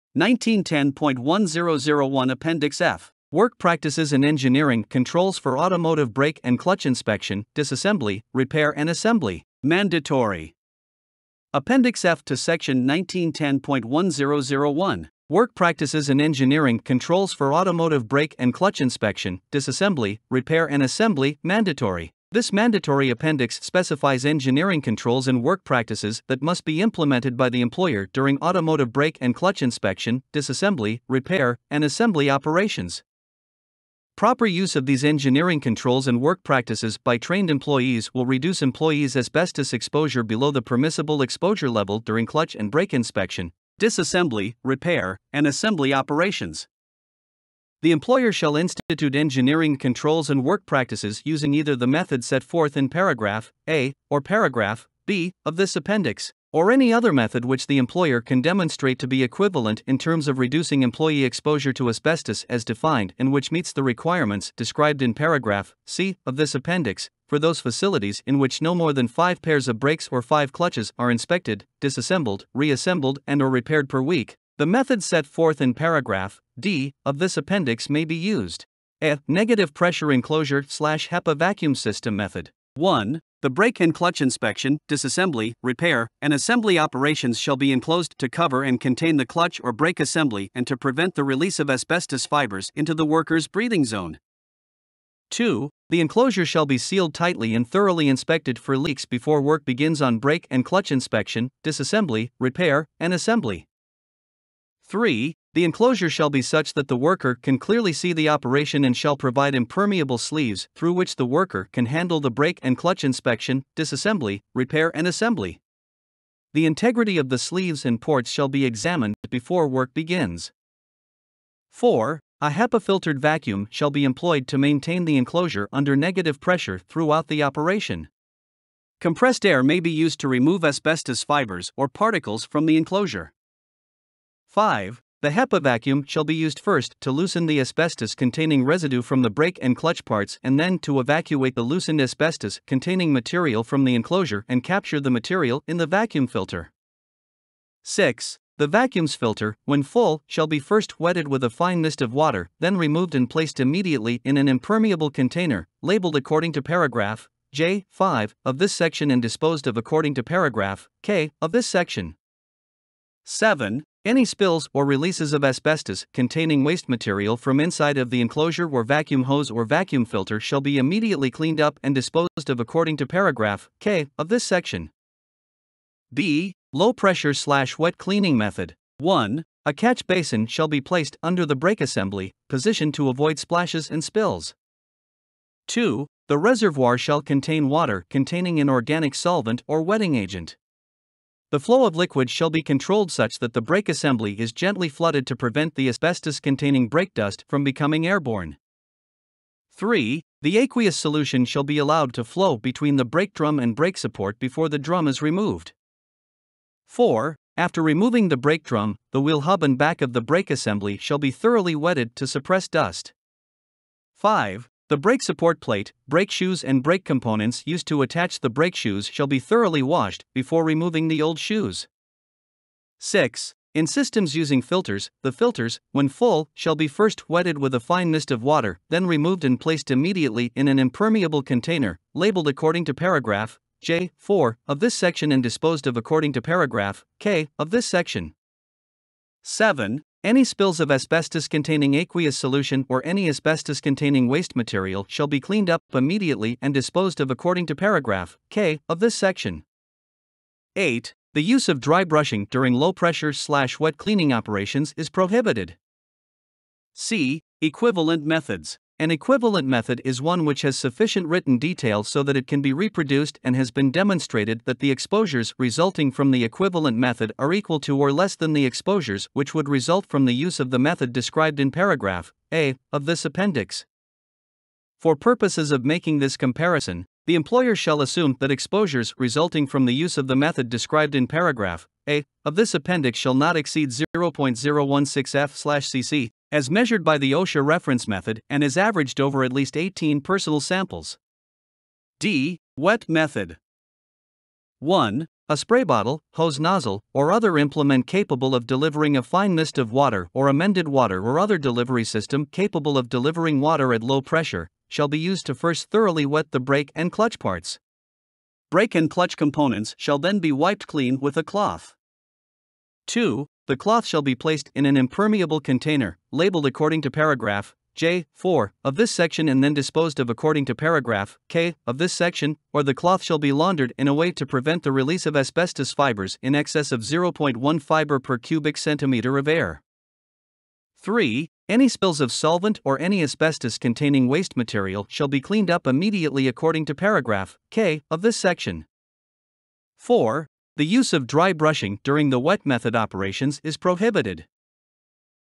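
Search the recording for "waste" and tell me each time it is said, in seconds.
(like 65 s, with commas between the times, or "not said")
166 s, 244 s, 334 s.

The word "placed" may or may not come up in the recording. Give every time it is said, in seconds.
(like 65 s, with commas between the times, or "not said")
153 s, 180 s, 229 s, 314 s.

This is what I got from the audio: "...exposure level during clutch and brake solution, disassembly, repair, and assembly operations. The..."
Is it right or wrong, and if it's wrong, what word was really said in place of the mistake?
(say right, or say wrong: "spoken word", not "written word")
wrong: "inspection", not "solution".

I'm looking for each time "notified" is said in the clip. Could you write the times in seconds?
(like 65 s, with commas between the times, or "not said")
not said.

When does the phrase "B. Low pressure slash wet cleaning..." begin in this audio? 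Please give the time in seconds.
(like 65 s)
176 s.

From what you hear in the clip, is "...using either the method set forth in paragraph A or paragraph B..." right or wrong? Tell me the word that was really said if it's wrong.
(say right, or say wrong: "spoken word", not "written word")
right.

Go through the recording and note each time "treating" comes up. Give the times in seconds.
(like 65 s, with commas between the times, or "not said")
not said.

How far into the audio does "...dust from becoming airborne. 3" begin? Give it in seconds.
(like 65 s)
197 s.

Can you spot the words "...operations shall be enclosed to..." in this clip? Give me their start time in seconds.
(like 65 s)
86 s.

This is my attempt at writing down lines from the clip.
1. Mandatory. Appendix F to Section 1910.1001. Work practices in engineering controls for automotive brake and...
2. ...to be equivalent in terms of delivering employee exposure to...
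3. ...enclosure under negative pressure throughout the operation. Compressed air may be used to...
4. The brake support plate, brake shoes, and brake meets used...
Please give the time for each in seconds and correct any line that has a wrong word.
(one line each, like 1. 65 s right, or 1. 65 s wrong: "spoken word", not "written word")
1. 9 s right
2. 58 s wrong: "reducing", not "delivering"
3. 125 s right
4. 214 s wrong: "components", not "meets".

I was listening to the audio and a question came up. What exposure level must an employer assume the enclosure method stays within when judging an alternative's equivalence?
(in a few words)
0.016 f/cc.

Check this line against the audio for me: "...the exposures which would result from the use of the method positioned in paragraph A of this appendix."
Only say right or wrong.
wrong.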